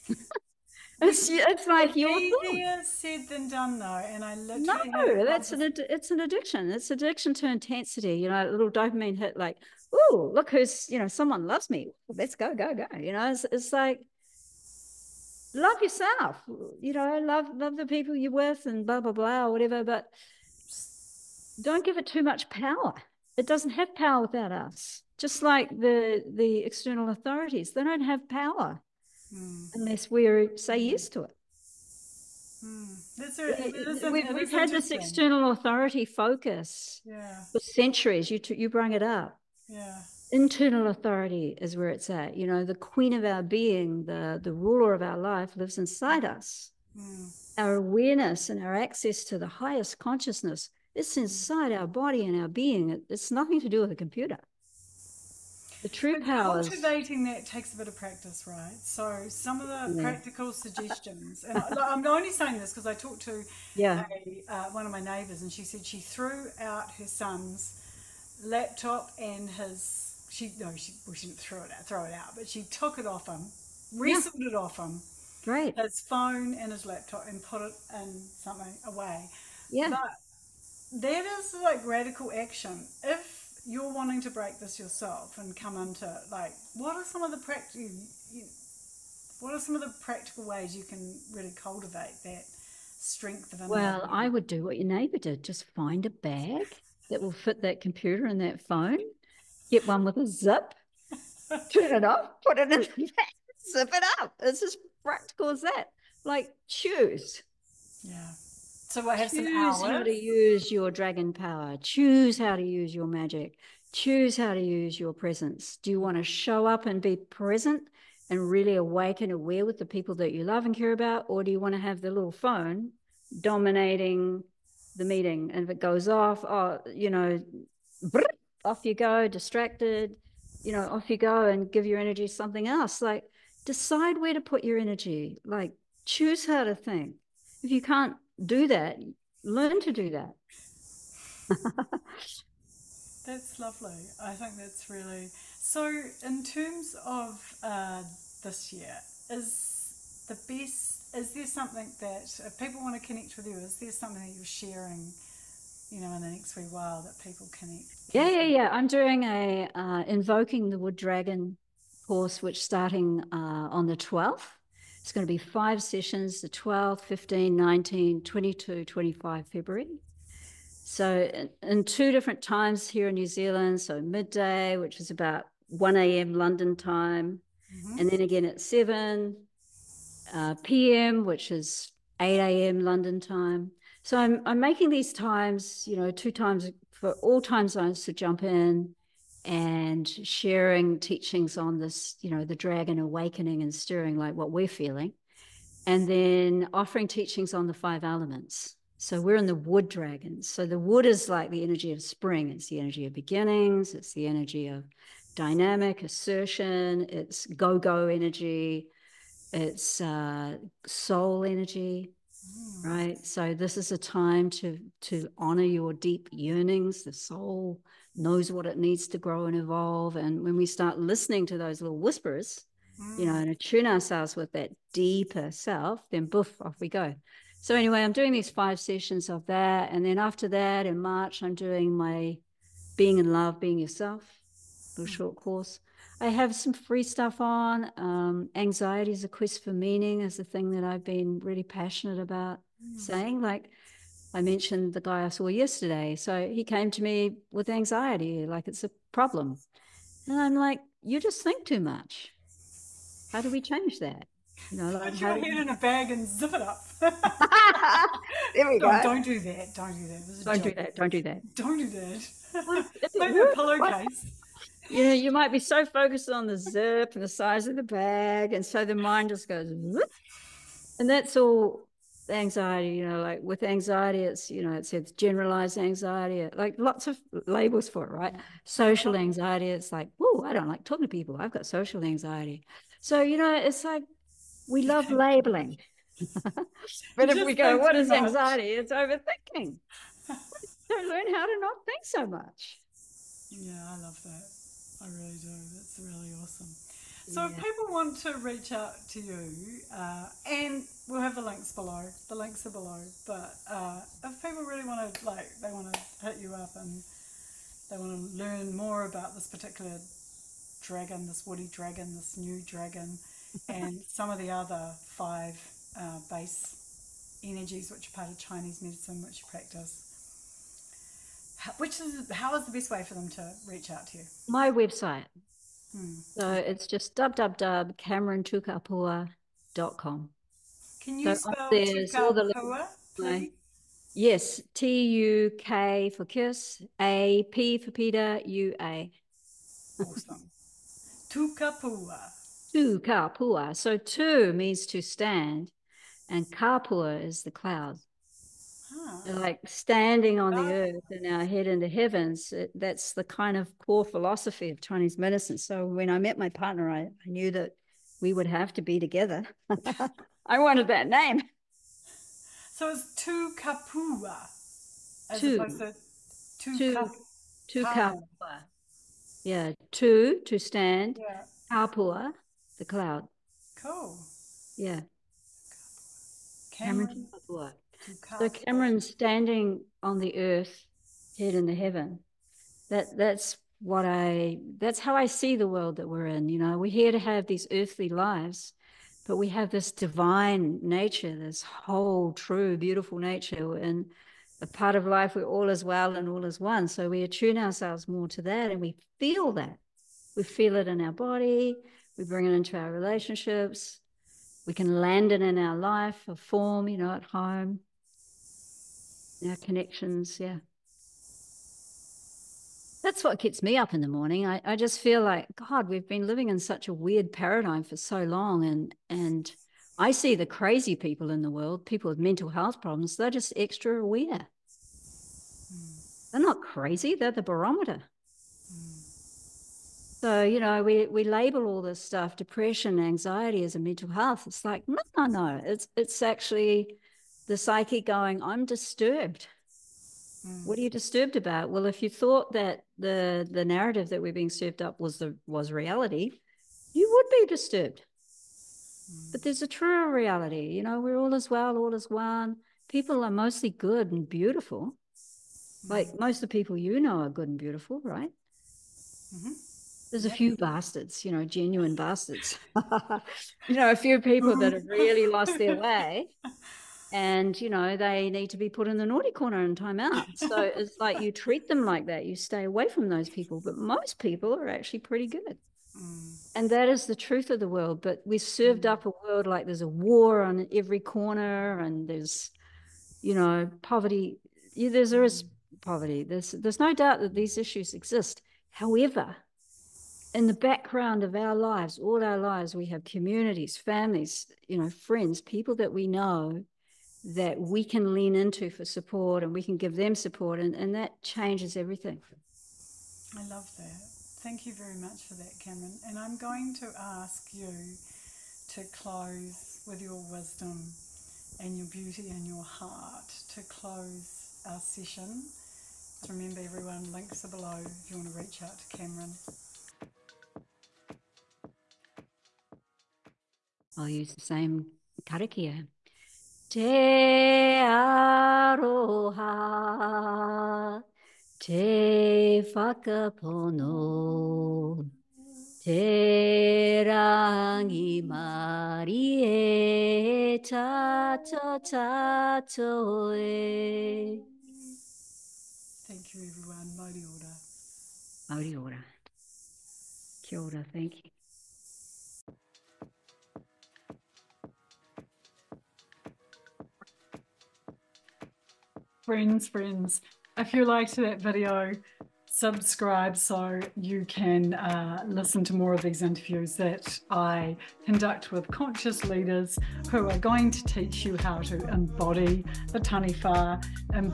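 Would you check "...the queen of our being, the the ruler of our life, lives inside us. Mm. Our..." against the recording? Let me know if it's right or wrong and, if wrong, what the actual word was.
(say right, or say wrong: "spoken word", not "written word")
right.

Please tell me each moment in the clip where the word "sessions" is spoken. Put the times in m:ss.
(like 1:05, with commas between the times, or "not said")
2:45, 3:48, 8:34.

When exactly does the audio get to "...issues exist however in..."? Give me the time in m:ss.
8:07.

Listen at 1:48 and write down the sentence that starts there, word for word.
yeah so I have Choose some how to use your dragon power.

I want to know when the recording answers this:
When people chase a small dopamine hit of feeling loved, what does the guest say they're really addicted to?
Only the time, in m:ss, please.
0:06.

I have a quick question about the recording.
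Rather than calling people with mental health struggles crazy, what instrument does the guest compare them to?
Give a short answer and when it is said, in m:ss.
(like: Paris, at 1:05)
Barometer, at 7:07.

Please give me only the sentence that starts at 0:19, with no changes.
But don't give it too much power.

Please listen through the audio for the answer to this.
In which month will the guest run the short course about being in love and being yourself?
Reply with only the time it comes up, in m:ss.
3:50.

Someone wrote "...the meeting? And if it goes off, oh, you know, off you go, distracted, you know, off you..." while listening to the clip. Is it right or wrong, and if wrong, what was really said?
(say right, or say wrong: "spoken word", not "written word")
right.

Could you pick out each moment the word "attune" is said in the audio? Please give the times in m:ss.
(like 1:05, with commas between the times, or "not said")
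3:43, 6:37.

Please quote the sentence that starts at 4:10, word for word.
And I'm like, you just think too much.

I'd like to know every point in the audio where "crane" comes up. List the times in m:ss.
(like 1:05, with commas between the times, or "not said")
not said.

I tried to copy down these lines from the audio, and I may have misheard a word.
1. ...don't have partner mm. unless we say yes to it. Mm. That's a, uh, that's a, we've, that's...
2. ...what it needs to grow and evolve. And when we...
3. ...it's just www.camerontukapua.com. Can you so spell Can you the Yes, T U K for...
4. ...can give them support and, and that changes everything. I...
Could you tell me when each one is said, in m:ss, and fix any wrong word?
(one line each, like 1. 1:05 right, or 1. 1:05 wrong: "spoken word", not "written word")
1. 0:27 wrong: "power", not "partner"
2. 3:38 right
3. 5:26 right
4. 8:19 right.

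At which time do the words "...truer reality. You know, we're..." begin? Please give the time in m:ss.
7:29.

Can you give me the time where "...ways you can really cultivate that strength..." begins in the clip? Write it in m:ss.
1:30.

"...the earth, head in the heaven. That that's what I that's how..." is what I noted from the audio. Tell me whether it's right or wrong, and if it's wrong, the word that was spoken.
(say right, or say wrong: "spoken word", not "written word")
right.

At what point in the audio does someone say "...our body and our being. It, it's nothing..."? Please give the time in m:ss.
0:51.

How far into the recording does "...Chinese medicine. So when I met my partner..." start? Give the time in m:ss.
5:54.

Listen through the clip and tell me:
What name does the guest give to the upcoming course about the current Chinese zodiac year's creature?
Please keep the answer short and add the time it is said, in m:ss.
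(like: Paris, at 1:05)
Invoking the wood dragon, at 2:40.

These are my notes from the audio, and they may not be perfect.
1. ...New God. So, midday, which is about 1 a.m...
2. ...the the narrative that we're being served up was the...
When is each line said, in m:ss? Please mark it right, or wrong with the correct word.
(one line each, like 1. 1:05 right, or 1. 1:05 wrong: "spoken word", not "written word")
1. 2:53 wrong: "Zealand", not "God"
2. 7:22 right.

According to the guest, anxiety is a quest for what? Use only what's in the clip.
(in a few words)
Meaning.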